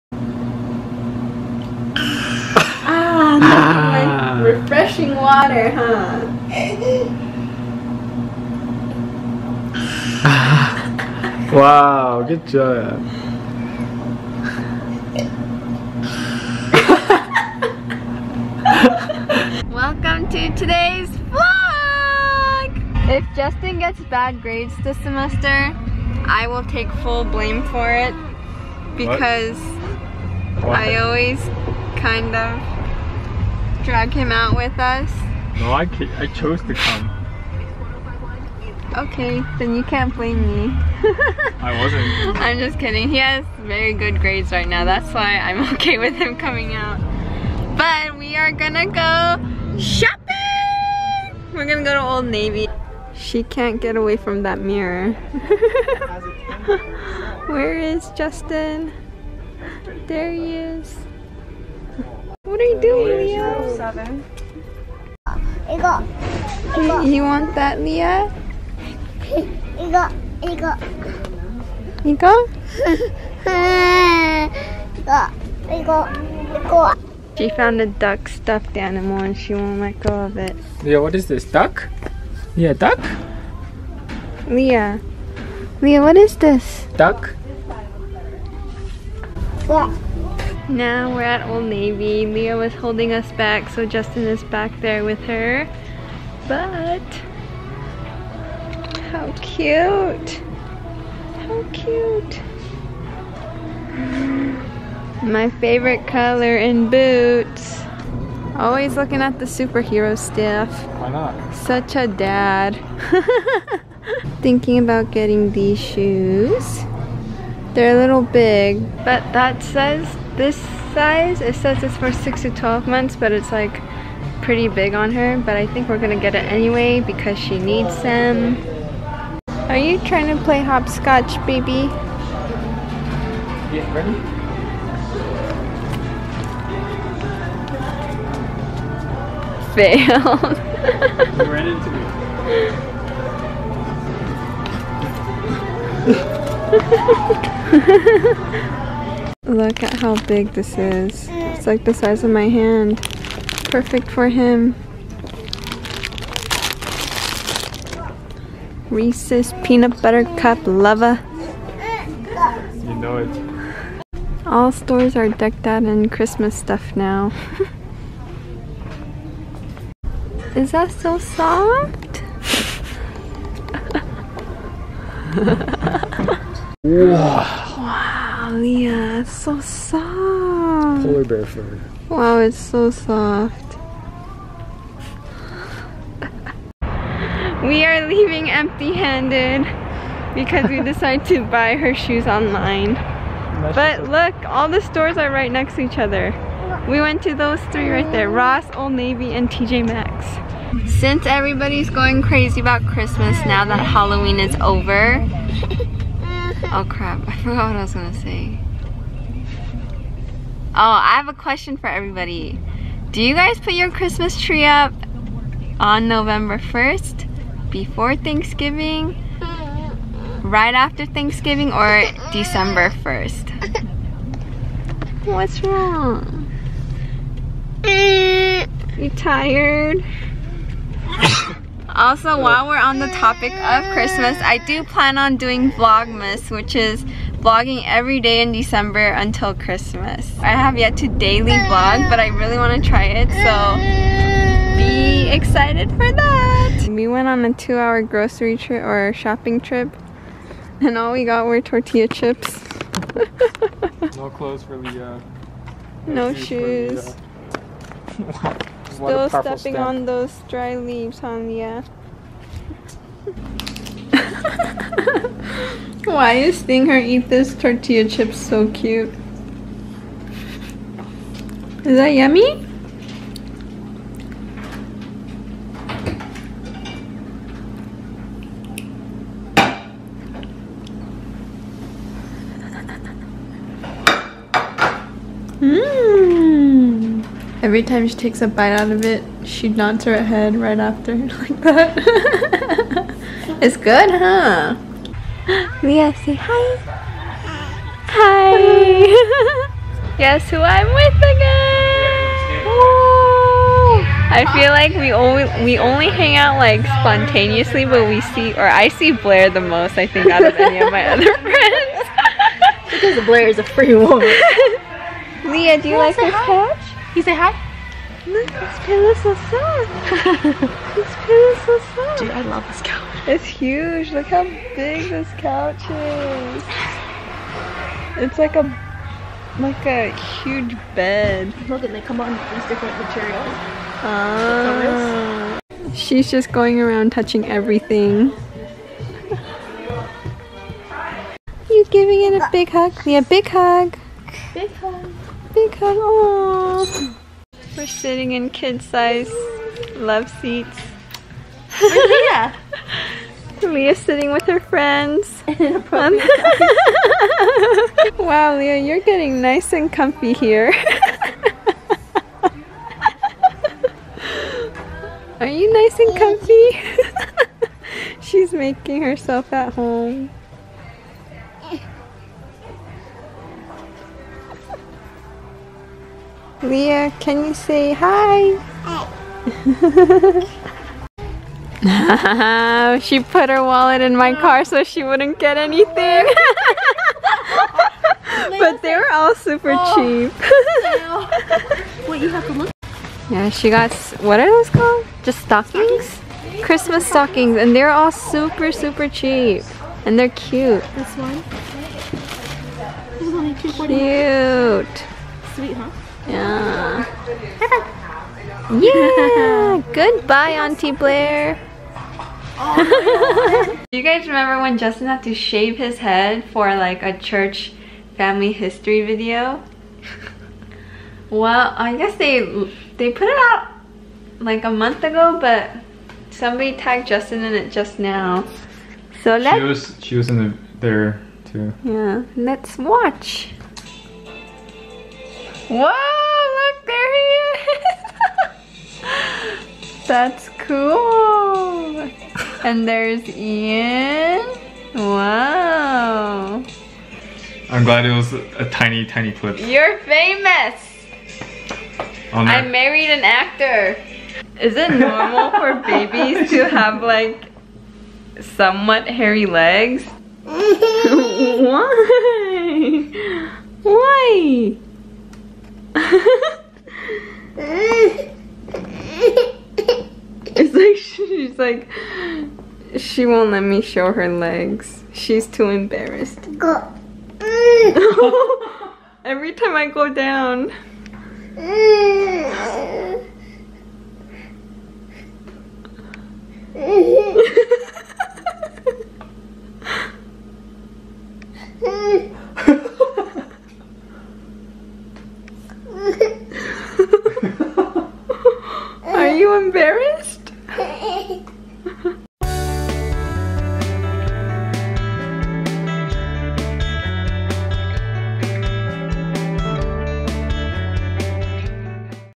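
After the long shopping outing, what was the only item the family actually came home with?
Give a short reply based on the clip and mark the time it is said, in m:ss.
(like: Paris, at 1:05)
Tortilla chips, at 4:11.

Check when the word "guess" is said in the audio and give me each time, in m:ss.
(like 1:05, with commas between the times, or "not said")
5:00, 7:01.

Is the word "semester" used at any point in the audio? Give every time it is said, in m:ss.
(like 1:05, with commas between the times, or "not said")
0:24.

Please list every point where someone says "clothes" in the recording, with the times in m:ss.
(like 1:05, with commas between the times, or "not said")
4:14.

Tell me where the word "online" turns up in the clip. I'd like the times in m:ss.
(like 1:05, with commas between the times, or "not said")
3:12.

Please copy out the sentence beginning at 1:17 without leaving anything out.
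She found a duck stuffed animal and she won't let go of it.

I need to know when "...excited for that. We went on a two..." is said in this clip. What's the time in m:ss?
4:05.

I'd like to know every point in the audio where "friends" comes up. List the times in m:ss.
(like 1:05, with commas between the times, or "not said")
5:11, 5:54.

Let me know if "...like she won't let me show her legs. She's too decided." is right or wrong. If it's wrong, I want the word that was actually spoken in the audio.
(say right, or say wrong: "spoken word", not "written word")
wrong: "embarrassed", not "decided".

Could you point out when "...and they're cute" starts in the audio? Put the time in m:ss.
6:40.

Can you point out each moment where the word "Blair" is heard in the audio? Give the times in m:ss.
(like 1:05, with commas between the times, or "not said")
5:09, 5:13, 6:50.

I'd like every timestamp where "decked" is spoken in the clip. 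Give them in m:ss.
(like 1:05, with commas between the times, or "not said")
2:45.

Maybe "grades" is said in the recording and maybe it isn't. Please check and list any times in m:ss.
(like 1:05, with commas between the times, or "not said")
0:24, 0:44.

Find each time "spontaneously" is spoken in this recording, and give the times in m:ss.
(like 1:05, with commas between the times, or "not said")
5:06.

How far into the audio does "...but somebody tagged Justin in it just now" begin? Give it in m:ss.
7:05.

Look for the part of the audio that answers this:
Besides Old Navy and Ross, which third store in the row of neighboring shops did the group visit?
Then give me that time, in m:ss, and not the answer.
3:19.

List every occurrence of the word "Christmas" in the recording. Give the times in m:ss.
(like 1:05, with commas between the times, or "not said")
2:46, 3:22, 3:33, 3:53, 3:59, 6:36.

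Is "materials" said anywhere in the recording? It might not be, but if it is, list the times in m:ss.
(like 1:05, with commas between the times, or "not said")
5:32.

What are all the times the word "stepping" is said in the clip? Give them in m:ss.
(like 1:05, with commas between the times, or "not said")
4:19.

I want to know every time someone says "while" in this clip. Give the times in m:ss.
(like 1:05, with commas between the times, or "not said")
3:52.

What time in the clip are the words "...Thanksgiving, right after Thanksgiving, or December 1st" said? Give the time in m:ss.
3:38.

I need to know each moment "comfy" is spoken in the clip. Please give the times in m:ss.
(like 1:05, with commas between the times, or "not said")
5:59, 6:06.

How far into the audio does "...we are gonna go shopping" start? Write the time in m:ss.
0:48.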